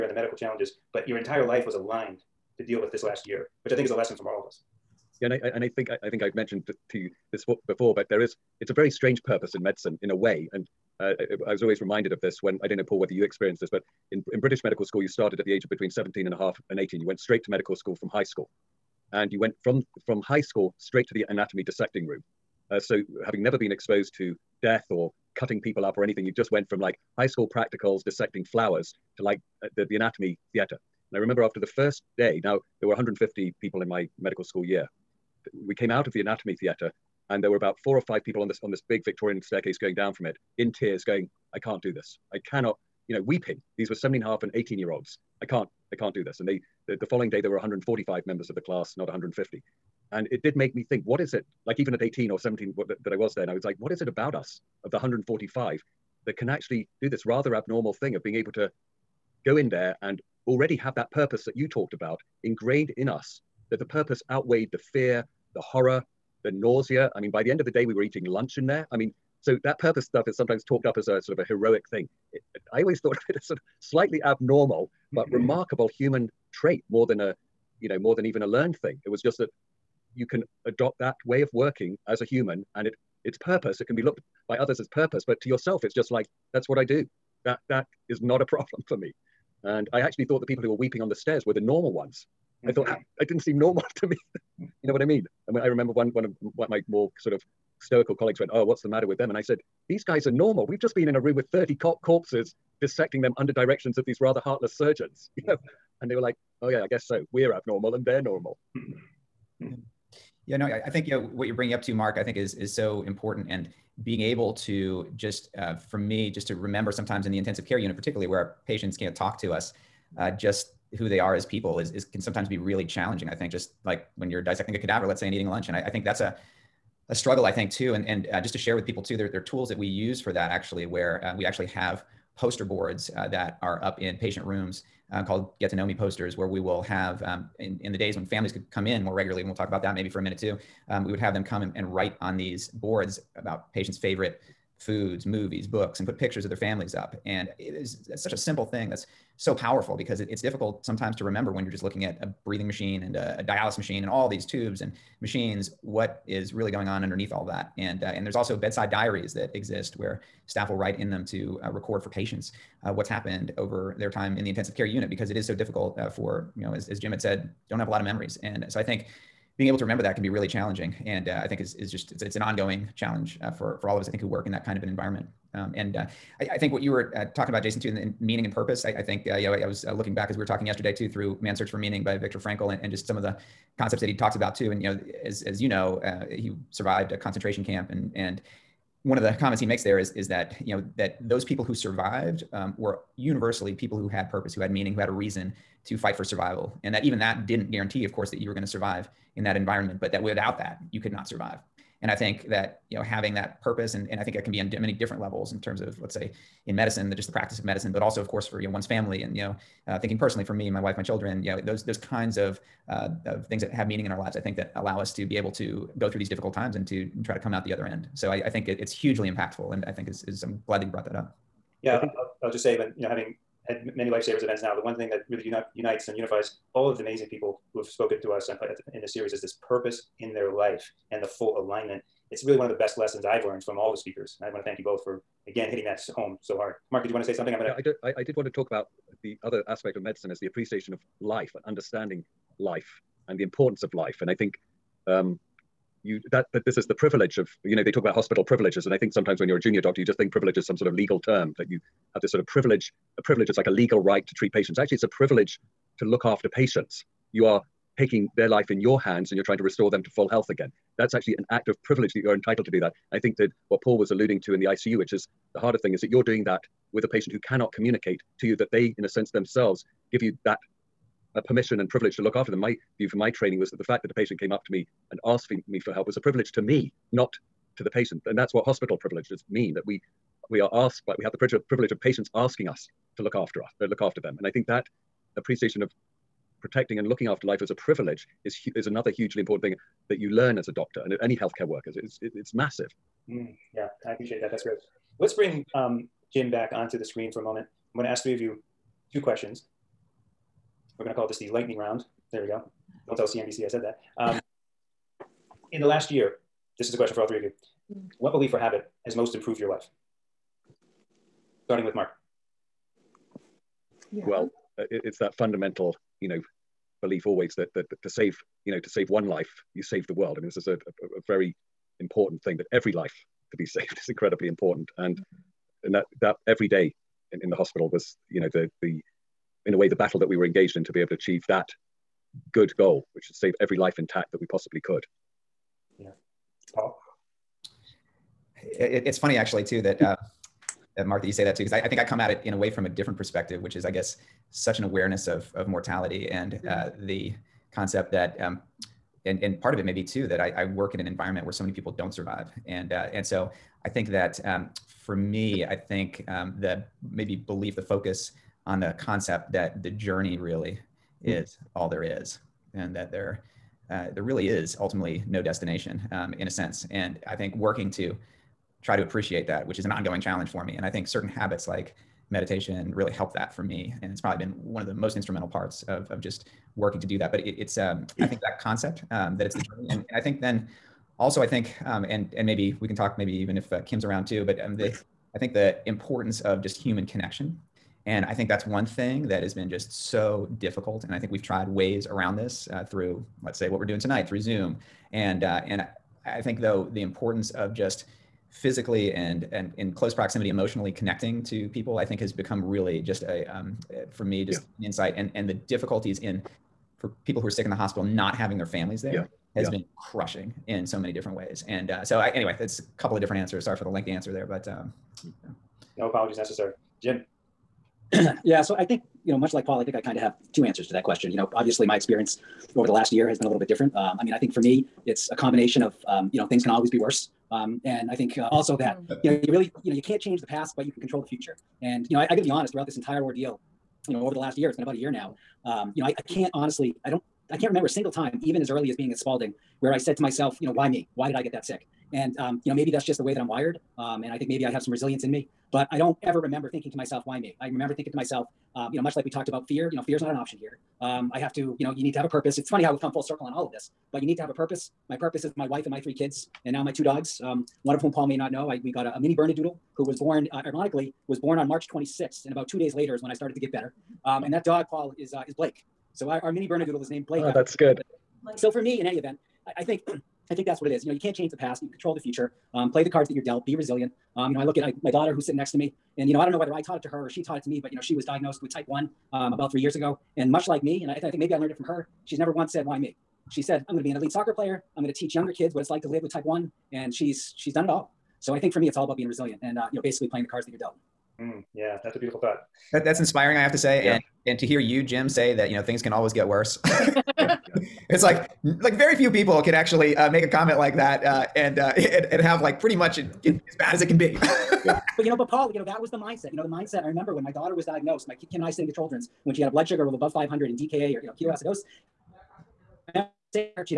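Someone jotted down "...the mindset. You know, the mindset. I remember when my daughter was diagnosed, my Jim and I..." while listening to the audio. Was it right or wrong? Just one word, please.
wrong.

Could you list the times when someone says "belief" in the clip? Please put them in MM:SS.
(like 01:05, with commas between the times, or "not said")
05:08, 05:17, 05:57.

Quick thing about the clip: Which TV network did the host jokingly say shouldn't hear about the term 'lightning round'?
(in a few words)
CNBC.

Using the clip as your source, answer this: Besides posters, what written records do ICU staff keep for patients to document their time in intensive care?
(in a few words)
Bedside diaries.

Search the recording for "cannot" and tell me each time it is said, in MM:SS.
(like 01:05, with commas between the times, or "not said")
00:42, 04:27.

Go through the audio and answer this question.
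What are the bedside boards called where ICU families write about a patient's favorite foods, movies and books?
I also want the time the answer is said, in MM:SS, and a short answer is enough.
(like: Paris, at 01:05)
Get to Know Me posters, at 02:15.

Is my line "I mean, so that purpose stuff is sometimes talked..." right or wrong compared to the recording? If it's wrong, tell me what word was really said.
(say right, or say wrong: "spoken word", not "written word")
right.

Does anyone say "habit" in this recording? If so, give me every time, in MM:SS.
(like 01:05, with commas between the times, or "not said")
05:08, 06:11.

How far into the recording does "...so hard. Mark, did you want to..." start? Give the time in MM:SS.
03:56.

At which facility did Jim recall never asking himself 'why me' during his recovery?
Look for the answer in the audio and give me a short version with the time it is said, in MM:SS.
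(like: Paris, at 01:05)
Spaulding, at 07:19.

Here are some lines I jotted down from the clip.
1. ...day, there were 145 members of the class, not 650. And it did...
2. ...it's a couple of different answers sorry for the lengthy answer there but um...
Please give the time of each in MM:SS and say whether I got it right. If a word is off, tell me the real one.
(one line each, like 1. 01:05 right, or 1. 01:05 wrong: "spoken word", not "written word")
1. 00:47 wrong: "150", not "650"
2. 06:52 right.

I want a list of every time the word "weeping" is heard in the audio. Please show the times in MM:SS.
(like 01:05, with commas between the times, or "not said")
00:43, 01:30.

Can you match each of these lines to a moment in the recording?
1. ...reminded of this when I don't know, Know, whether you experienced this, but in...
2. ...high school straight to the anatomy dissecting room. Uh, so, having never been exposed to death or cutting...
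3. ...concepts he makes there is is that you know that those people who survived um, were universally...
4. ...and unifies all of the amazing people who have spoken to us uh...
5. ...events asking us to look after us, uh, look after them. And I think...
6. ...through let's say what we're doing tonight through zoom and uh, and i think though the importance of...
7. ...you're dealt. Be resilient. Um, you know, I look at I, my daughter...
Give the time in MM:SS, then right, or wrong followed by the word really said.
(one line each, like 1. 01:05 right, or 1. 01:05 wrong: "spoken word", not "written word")
1. 00:11 wrong: "Paul", not "Know"
2. 00:20 right
3. 03:09 wrong: "comments", not "concepts"
4. 03:46 right
5. 04:42 wrong: "patients", not "events"
6. 06:32 right
7. 07:53 right.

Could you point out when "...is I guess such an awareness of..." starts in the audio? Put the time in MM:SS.
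05:43.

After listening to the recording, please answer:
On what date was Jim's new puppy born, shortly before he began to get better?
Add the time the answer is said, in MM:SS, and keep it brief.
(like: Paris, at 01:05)
March 26th, at 07:41.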